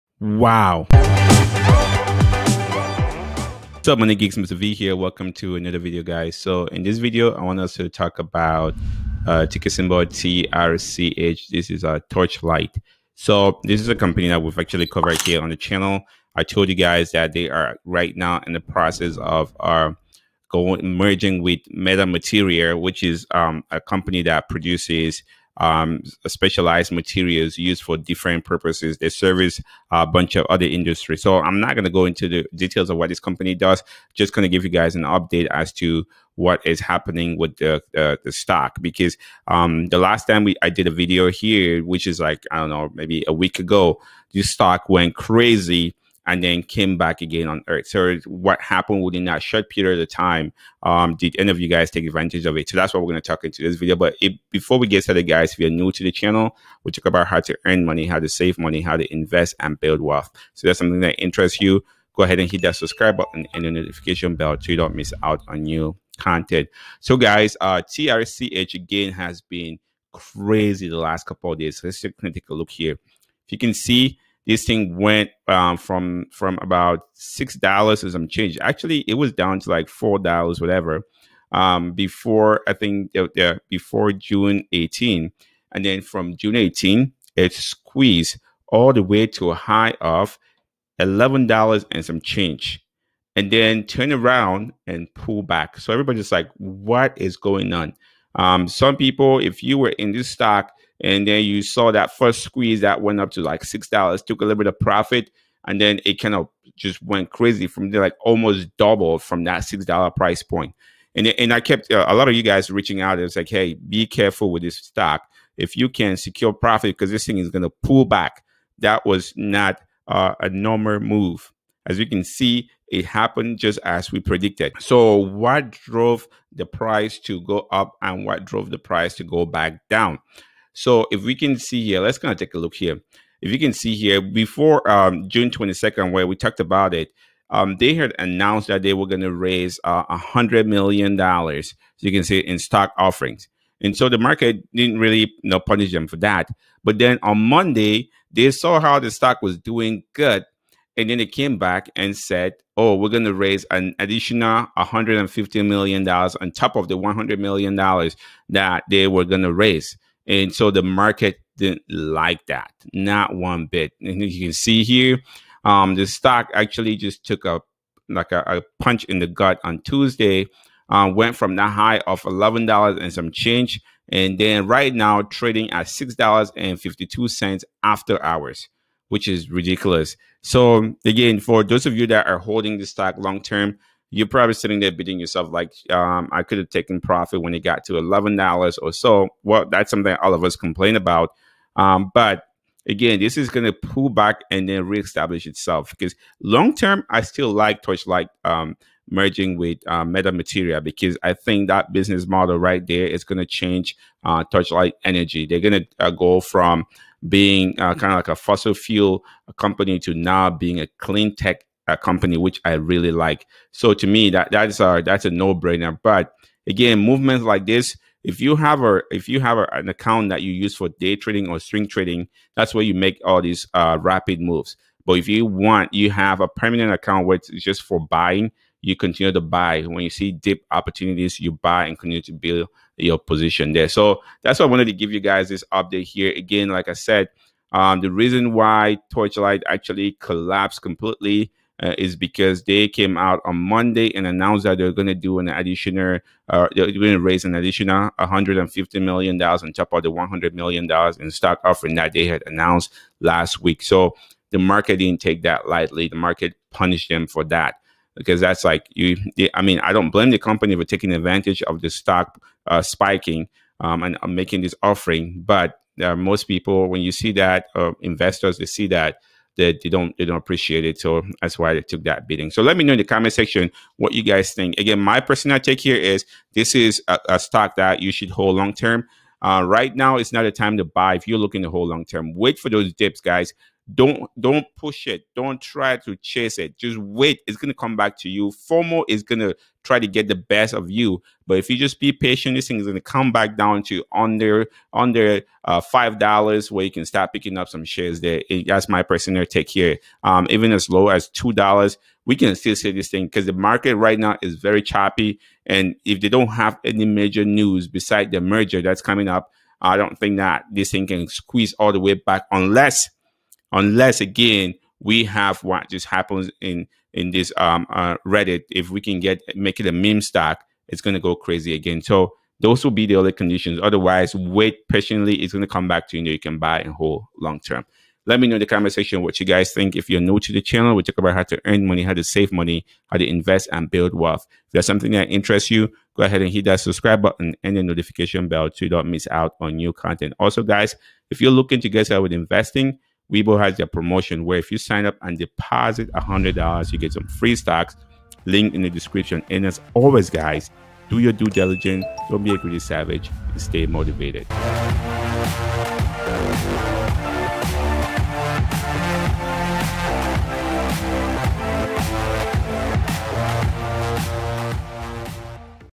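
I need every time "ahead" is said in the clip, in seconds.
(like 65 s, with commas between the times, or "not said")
62 s, 336 s.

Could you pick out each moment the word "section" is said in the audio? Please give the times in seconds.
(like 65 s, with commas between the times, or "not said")
273 s, 328 s.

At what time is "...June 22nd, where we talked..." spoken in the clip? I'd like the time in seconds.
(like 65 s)
135 s.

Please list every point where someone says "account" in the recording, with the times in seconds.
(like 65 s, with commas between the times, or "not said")
219 s, 226 s.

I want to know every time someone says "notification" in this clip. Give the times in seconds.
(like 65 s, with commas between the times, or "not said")
63 s, 337 s.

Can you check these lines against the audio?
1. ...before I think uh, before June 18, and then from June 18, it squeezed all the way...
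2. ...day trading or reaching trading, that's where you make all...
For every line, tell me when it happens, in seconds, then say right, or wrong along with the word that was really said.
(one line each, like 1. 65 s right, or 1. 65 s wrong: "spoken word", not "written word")
1. 81 s right
2. 220 s wrong: "swing", not "reaching".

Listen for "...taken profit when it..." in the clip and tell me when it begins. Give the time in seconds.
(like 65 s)
186 s.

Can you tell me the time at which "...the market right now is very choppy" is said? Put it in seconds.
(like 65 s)
303 s.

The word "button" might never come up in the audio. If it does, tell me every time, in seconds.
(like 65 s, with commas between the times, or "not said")
63 s, 337 s.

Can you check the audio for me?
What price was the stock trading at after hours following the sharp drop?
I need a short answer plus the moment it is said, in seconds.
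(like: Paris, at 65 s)
$6.52, at 175 s.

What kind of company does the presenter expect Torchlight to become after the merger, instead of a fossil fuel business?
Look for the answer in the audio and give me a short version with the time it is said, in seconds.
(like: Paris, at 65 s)
clean tech, at 210 s.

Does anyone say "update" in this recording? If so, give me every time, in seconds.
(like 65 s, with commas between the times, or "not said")
35 s, 235 s.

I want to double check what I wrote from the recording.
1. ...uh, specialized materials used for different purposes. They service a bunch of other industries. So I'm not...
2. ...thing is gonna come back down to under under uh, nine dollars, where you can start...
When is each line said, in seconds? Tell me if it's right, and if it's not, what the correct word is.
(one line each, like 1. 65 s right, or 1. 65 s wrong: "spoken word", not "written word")
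1. 26 s right
2. 292 s wrong: "five", not "nine".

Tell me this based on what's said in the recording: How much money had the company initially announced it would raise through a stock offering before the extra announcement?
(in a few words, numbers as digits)
$100 million.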